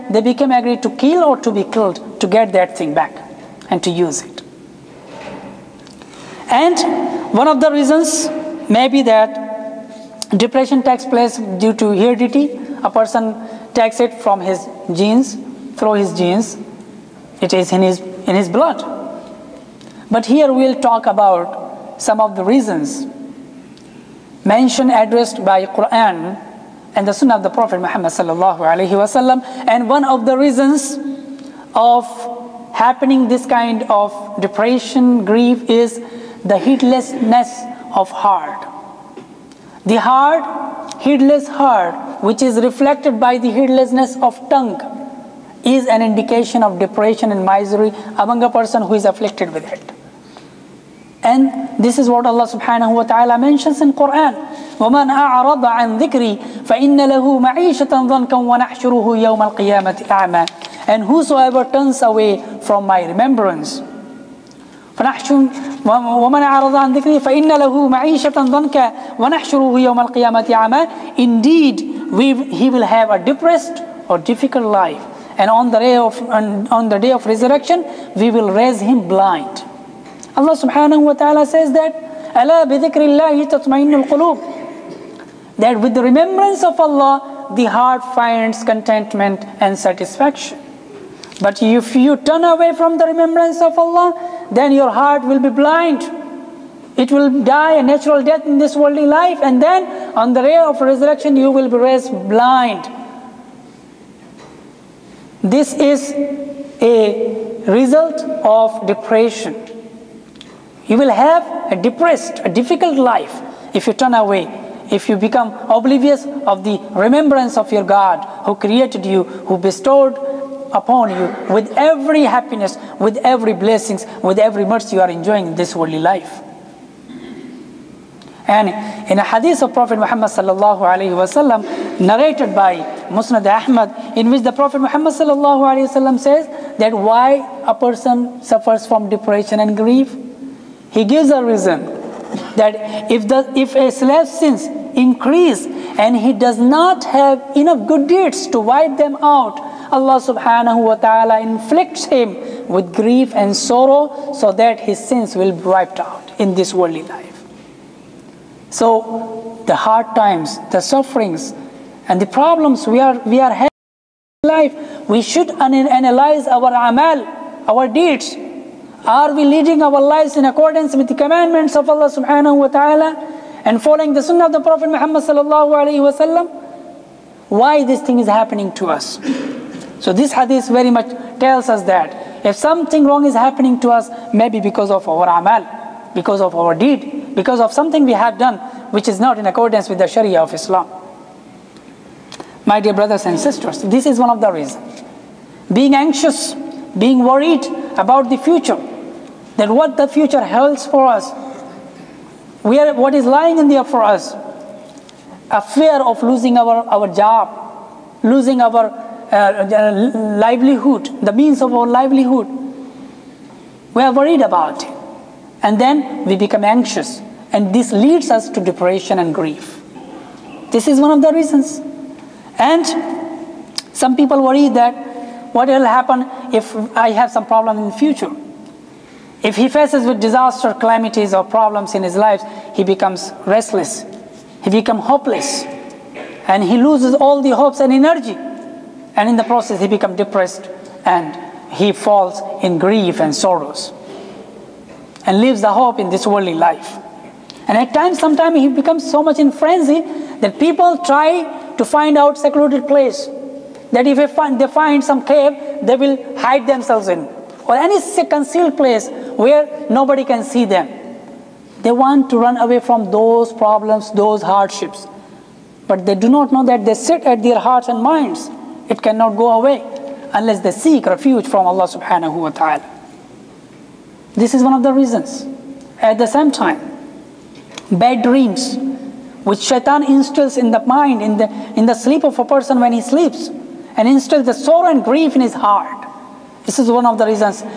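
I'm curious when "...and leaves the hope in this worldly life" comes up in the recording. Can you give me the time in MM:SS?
04:05.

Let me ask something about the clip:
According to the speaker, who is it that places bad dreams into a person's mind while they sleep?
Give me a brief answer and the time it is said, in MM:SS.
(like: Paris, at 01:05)
Shaitan, at 04:39.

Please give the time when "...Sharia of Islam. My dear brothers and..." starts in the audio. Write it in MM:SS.
03:10.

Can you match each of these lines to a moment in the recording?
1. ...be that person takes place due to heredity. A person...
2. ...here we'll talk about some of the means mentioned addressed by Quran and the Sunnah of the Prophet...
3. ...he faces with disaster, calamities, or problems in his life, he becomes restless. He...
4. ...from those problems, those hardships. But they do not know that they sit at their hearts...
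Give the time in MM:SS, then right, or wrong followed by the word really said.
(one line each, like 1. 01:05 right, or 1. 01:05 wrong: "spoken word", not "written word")
1. 00:08 wrong: "depression", not "person"
2. 00:20 wrong: "reasons", not "means"
3. 03:49 right
4. 04:22 right.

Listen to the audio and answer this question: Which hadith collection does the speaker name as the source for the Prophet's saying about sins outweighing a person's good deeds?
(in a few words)
Musnad Ahmad.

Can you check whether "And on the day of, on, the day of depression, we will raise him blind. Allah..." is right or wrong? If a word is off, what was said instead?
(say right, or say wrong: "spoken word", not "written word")
wrong: "resurrection", not "depression".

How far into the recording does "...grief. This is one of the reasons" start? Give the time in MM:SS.
03:39.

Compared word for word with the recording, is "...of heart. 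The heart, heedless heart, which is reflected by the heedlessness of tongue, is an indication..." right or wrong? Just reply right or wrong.
right.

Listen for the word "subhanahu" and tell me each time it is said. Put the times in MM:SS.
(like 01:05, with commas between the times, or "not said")
00:52, 01:20, 02:30, 02:52, 04:31.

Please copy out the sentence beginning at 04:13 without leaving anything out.
That if they find, they find some cave, they will hide themselves in.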